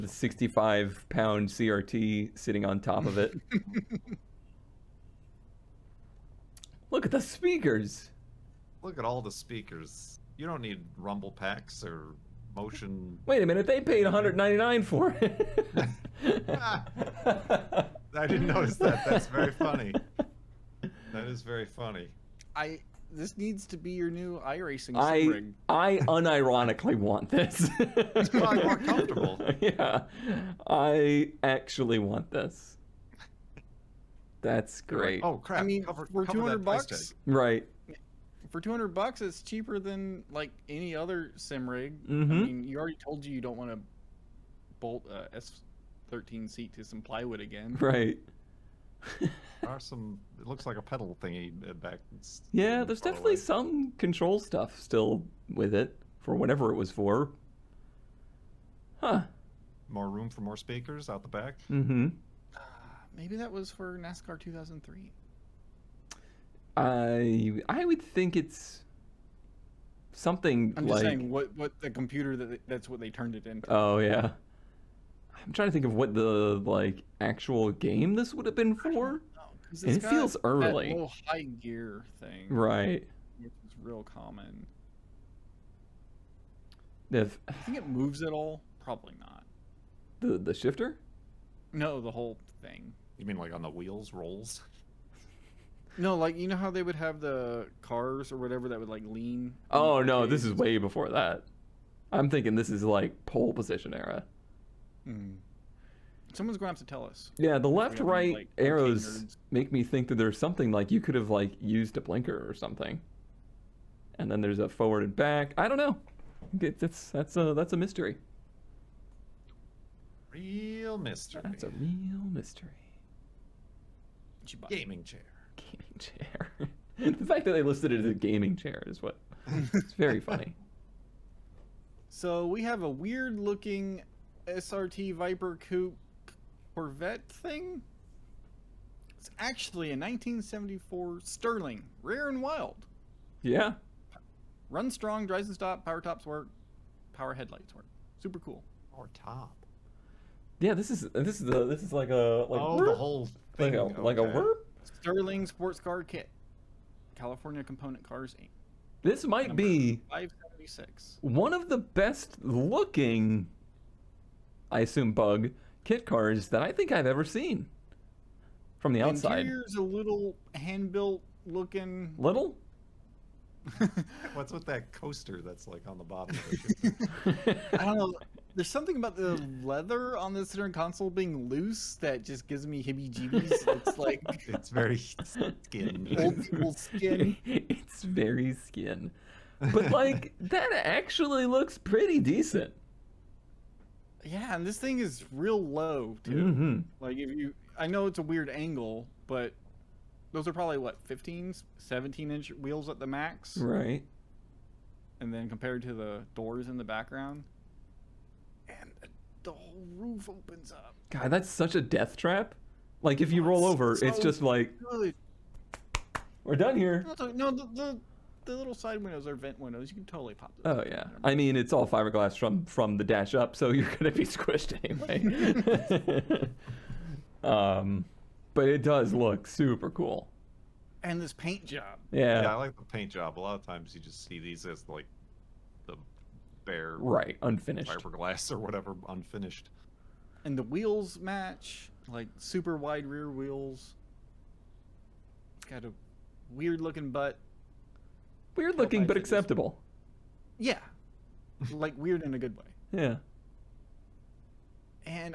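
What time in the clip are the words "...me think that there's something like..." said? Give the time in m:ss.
1:49.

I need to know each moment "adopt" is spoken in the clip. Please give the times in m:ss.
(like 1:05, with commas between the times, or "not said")
not said.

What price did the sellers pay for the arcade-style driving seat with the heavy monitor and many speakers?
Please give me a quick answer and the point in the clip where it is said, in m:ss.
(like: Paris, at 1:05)
$199, at 0:14.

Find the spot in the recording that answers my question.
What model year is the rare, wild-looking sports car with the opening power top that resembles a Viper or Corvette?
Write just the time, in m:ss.
2:19.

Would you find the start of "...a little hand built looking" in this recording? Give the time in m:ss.
2:49.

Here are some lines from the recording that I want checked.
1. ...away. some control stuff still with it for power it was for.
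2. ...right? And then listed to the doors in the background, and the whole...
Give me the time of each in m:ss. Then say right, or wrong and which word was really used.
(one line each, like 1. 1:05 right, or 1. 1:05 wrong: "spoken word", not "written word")
1. 0:53 wrong: "whatever", not "power"
2. 3:23 wrong: "compared", not "listed".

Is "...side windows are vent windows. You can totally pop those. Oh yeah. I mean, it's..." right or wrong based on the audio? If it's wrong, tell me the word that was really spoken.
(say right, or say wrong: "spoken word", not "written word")
right.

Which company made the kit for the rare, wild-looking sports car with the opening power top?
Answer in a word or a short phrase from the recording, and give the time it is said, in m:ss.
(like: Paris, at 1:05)
California Component Cars Inc., at 2:37.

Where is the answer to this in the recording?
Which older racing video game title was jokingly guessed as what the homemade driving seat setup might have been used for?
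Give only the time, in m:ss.
1:03.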